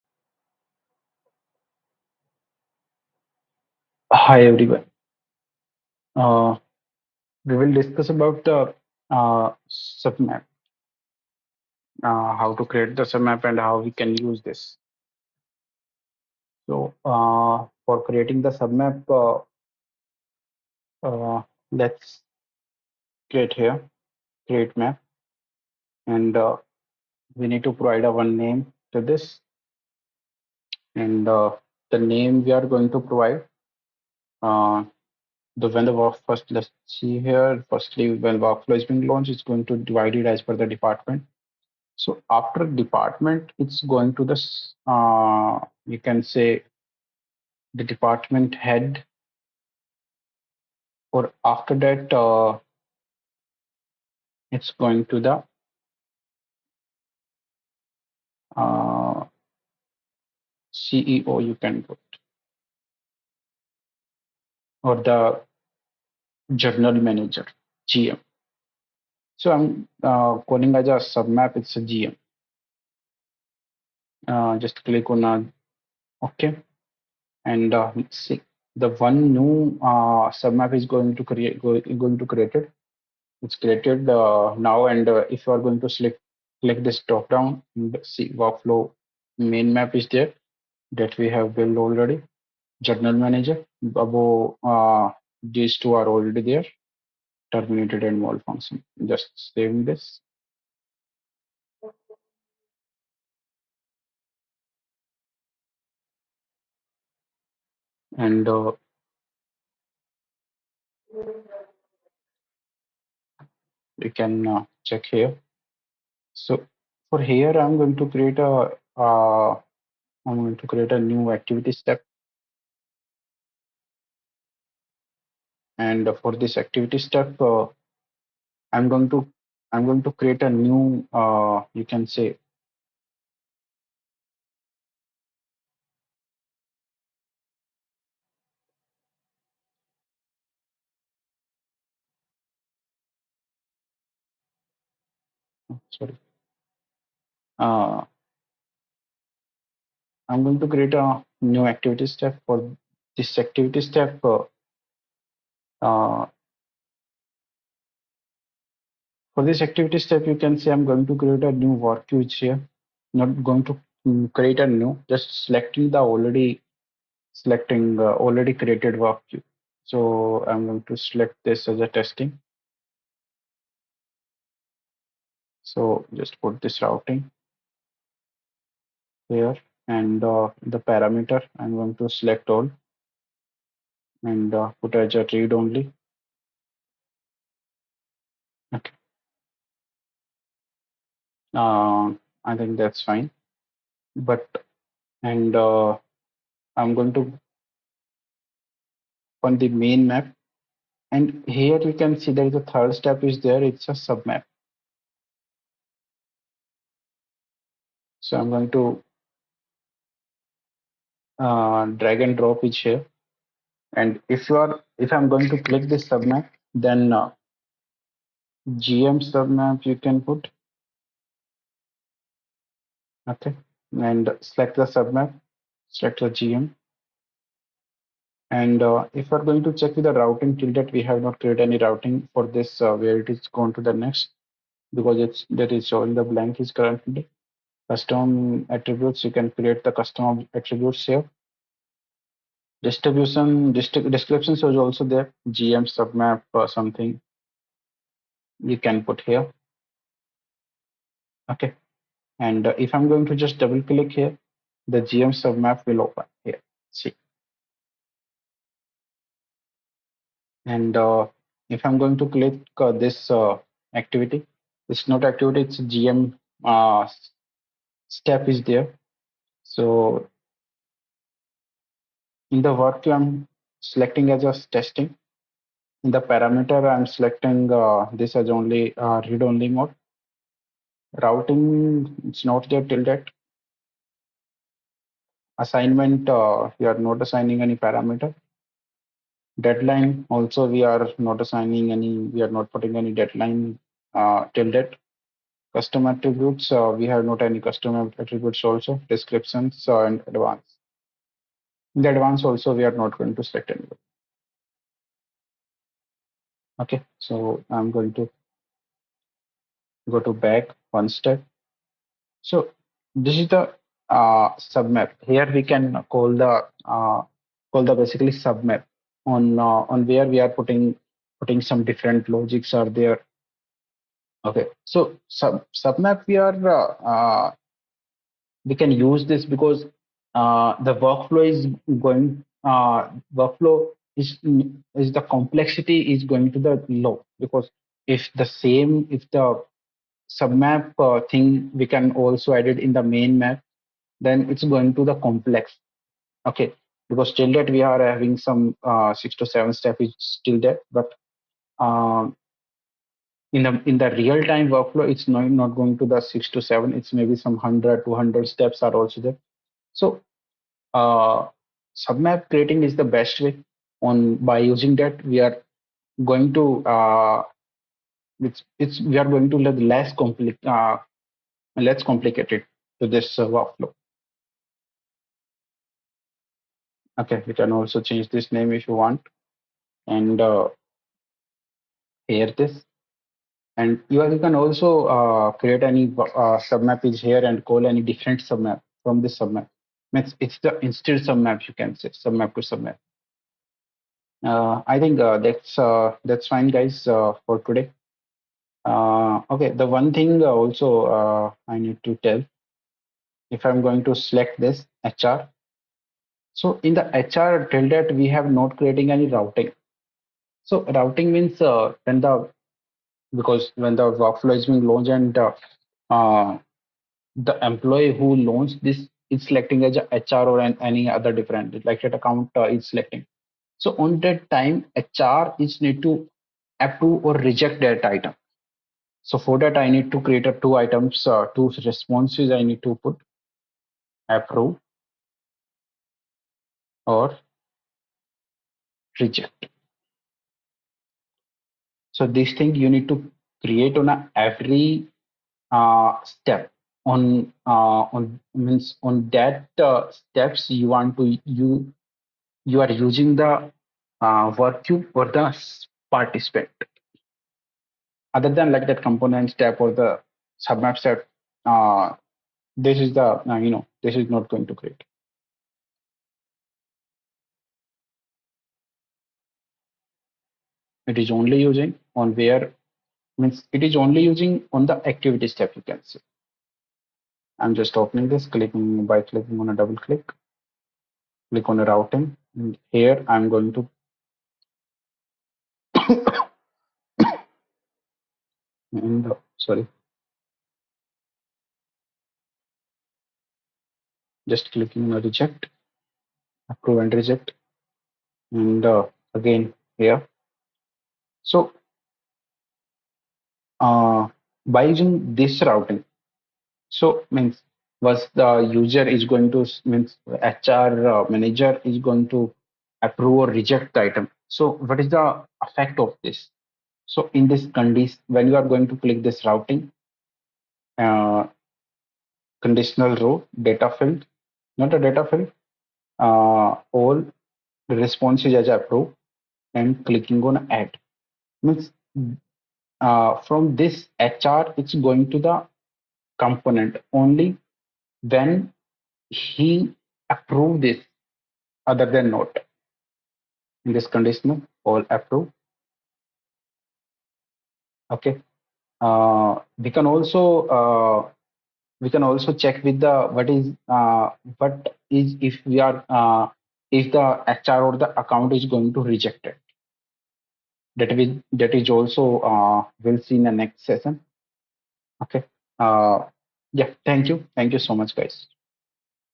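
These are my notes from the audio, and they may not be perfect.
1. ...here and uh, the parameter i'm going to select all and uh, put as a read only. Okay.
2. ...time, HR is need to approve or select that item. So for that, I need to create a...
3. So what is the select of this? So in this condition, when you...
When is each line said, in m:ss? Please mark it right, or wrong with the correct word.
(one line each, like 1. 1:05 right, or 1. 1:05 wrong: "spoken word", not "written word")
1. 2:59 right
2. 7:04 wrong: "reject", not "select"
3. 8:34 wrong: "effect", not "select".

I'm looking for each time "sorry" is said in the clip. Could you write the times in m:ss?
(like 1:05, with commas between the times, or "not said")
2:25, 8:09.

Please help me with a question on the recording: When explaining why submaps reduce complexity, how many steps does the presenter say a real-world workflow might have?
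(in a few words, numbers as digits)
200.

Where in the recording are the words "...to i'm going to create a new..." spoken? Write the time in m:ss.
2:09.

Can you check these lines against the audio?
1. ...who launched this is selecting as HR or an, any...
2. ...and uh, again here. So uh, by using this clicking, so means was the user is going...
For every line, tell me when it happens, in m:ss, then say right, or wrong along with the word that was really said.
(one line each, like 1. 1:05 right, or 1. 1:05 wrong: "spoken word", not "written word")
1. 6:58 right
2. 8:18 wrong: "routing", not "clicking".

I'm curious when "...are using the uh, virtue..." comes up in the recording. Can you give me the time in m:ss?
7:32.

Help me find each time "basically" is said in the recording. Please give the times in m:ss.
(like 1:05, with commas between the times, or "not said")
5:17.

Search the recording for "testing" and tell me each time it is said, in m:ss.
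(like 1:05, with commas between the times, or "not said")
2:51, 4:34.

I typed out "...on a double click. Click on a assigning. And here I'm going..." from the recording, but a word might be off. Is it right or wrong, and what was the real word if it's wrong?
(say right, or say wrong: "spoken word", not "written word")
wrong: "routing", not "assigning".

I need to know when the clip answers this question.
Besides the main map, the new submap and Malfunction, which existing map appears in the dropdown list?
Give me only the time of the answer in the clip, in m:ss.
1:37.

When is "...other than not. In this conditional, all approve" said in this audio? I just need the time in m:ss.
9:01.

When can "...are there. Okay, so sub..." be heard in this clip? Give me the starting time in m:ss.
5:22.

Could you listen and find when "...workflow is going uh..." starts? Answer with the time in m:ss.
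5:30.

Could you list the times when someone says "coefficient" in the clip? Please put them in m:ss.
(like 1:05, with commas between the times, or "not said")
not said.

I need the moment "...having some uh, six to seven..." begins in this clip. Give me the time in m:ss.
5:48.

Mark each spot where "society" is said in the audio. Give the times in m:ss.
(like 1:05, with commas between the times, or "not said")
not said.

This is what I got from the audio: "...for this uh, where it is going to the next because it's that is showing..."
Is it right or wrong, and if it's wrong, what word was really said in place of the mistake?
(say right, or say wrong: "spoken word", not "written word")
right.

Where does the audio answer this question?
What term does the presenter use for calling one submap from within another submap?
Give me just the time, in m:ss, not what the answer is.
6:32.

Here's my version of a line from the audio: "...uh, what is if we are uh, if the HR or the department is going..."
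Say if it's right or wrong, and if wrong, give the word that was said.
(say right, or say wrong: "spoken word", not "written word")
wrong: "account", not "department".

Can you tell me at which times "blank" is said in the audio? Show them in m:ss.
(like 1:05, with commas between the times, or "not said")
3:56.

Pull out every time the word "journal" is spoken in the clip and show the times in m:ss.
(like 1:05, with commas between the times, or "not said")
1:06, 1:32.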